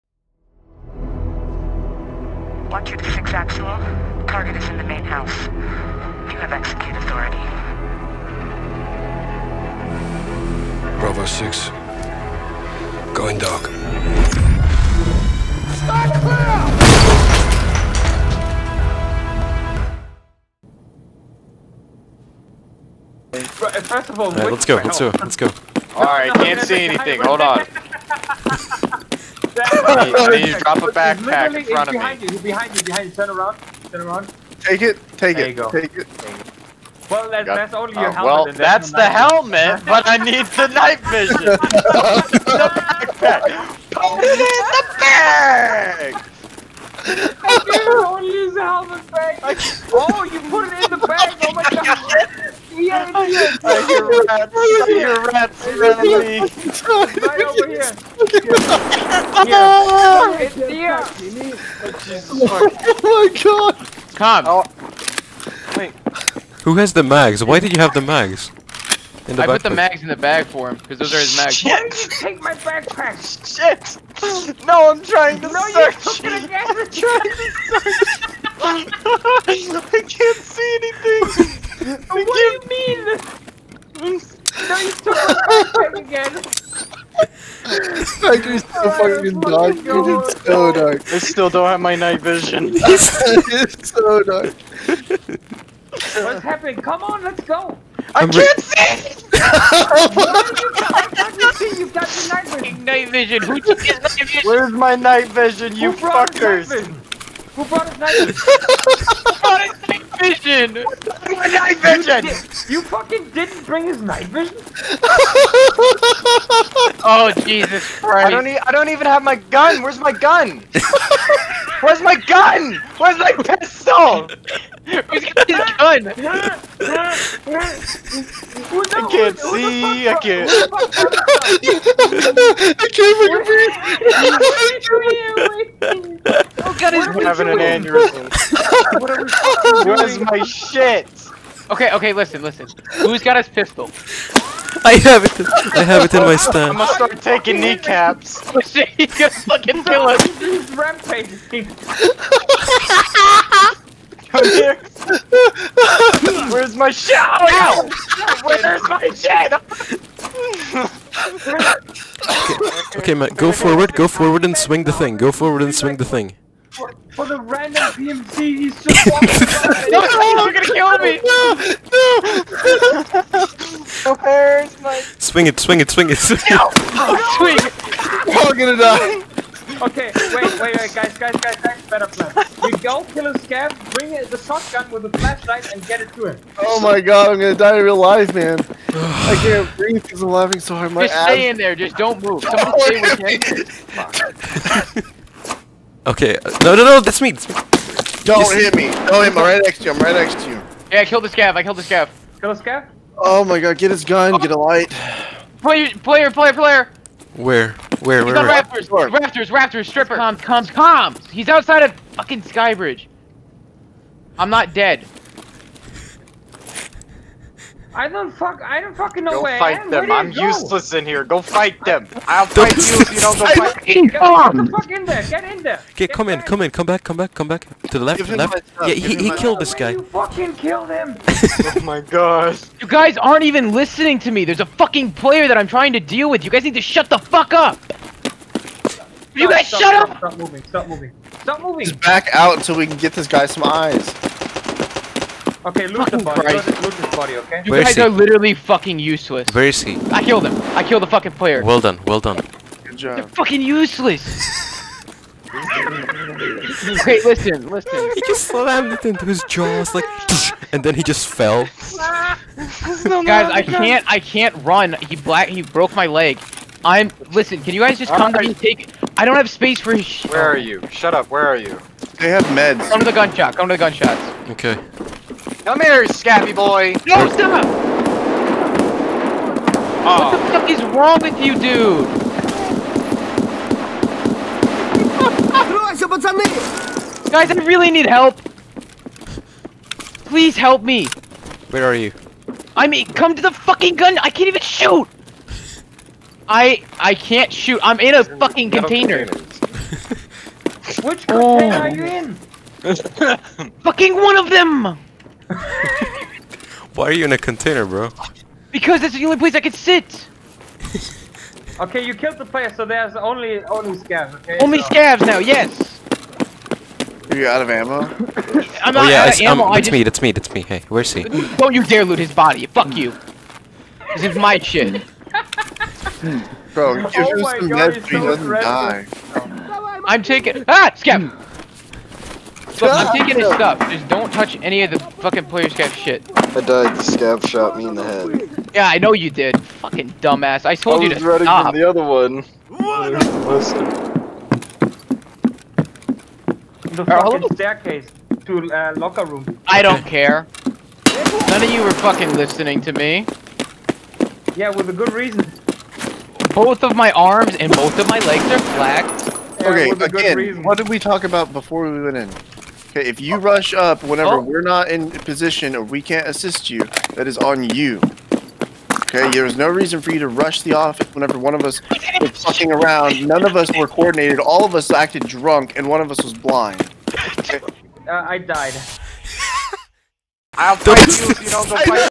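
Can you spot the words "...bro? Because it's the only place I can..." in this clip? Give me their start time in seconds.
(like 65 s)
307 s.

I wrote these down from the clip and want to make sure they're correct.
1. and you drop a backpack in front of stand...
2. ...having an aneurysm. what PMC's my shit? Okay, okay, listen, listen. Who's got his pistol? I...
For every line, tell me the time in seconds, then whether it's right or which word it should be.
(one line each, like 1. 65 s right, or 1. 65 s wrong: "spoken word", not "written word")
1. 30 s wrong: "behind", not "stand"
2. 137 s wrong: "Where", not "PMC".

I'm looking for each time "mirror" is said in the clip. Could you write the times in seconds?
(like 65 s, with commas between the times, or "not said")
not said.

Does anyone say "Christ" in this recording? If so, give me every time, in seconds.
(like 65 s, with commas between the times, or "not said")
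117 s, 246 s.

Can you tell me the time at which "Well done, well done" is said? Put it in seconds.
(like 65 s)
251 s.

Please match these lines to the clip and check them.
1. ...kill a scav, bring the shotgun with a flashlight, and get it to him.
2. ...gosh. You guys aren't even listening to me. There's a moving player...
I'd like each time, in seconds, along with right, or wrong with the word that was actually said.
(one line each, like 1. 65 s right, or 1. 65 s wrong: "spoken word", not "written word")
1. 183 s right
2. 231 s wrong: "fucking", not "moving".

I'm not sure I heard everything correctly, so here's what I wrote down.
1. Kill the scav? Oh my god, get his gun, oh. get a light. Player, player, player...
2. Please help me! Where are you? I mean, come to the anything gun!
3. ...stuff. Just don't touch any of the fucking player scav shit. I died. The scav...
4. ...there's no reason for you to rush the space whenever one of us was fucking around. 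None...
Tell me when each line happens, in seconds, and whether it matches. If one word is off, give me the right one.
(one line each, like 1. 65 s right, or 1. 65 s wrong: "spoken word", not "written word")
1. 202 s right
2. 290 s wrong: "fucking", not "anything"
3. 333 s right
4. 369 s wrong: "office", not "space".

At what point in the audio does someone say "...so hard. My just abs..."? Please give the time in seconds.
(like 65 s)
190 s.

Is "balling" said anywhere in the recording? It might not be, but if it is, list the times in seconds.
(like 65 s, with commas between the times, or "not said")
not said.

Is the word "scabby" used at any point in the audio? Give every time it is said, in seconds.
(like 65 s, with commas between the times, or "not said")
276 s.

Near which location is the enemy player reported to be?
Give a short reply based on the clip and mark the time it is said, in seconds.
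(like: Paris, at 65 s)
Skybridge, at 212 s.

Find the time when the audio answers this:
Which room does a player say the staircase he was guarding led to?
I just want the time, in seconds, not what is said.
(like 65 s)
348 s.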